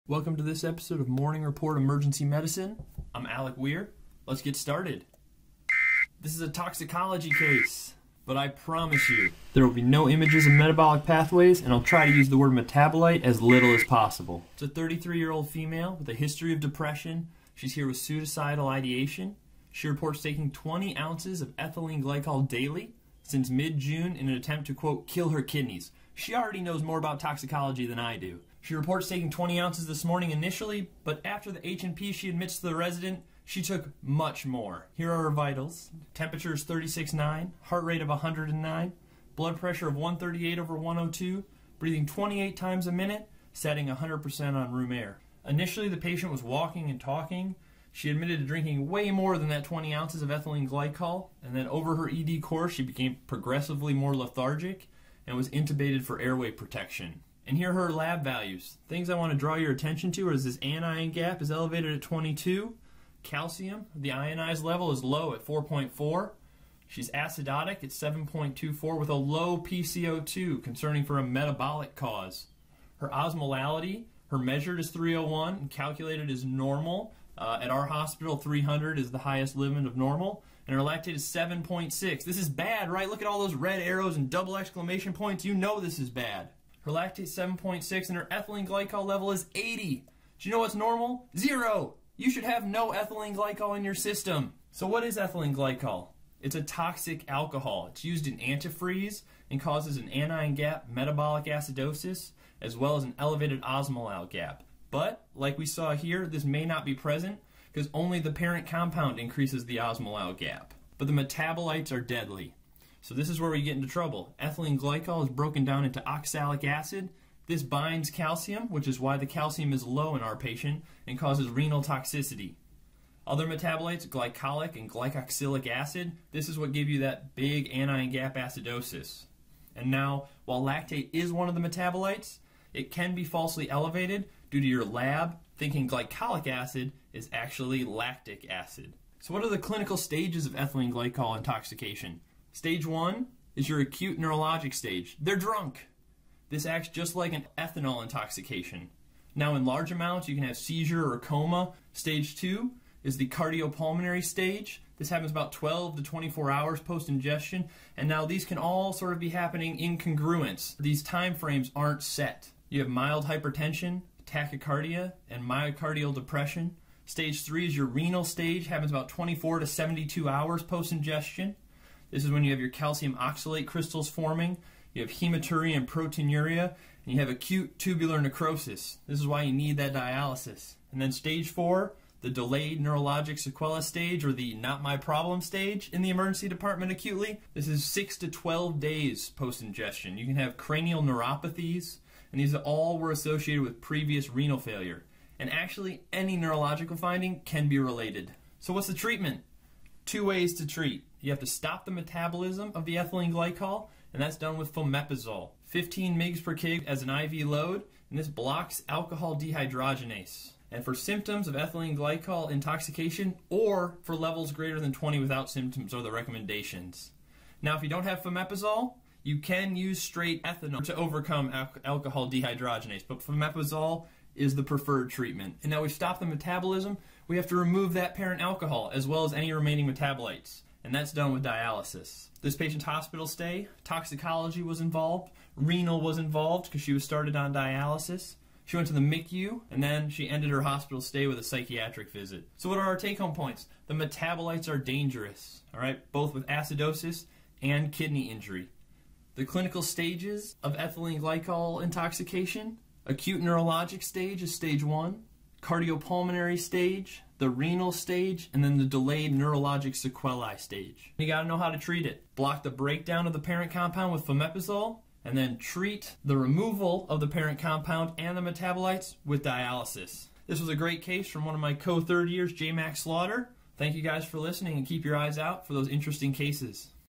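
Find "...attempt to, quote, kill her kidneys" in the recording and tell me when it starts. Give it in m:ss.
0:24.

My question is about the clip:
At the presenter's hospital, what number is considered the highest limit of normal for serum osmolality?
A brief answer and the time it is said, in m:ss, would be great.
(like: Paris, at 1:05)
300, at 1:18.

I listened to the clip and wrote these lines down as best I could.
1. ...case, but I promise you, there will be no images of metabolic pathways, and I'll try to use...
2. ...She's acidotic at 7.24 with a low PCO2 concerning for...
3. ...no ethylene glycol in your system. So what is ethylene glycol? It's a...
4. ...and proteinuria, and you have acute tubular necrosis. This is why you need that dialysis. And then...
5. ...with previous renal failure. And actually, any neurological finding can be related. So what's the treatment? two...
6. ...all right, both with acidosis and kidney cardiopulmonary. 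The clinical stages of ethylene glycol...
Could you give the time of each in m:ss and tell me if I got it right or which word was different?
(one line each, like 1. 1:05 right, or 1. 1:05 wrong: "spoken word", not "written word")
1. 0:07 right
2. 1:06 right
3. 1:32 right
4. 2:55 right
5. 3:13 right
6. 4:05 wrong: "injury", not "cardiopulmonary".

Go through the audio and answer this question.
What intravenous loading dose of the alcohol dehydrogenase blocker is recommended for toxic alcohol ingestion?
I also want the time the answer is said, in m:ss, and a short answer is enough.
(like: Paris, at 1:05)
15 mg per kg, at 3:25.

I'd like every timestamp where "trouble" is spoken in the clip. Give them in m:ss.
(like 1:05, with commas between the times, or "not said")
1:53.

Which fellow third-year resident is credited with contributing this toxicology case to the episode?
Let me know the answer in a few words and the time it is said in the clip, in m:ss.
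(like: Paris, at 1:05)
J. Max Slaughter, at 4:32.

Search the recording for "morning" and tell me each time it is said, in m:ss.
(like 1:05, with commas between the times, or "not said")
0:01, 0:30.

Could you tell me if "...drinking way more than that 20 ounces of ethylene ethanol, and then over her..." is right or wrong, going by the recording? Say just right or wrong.
wrong.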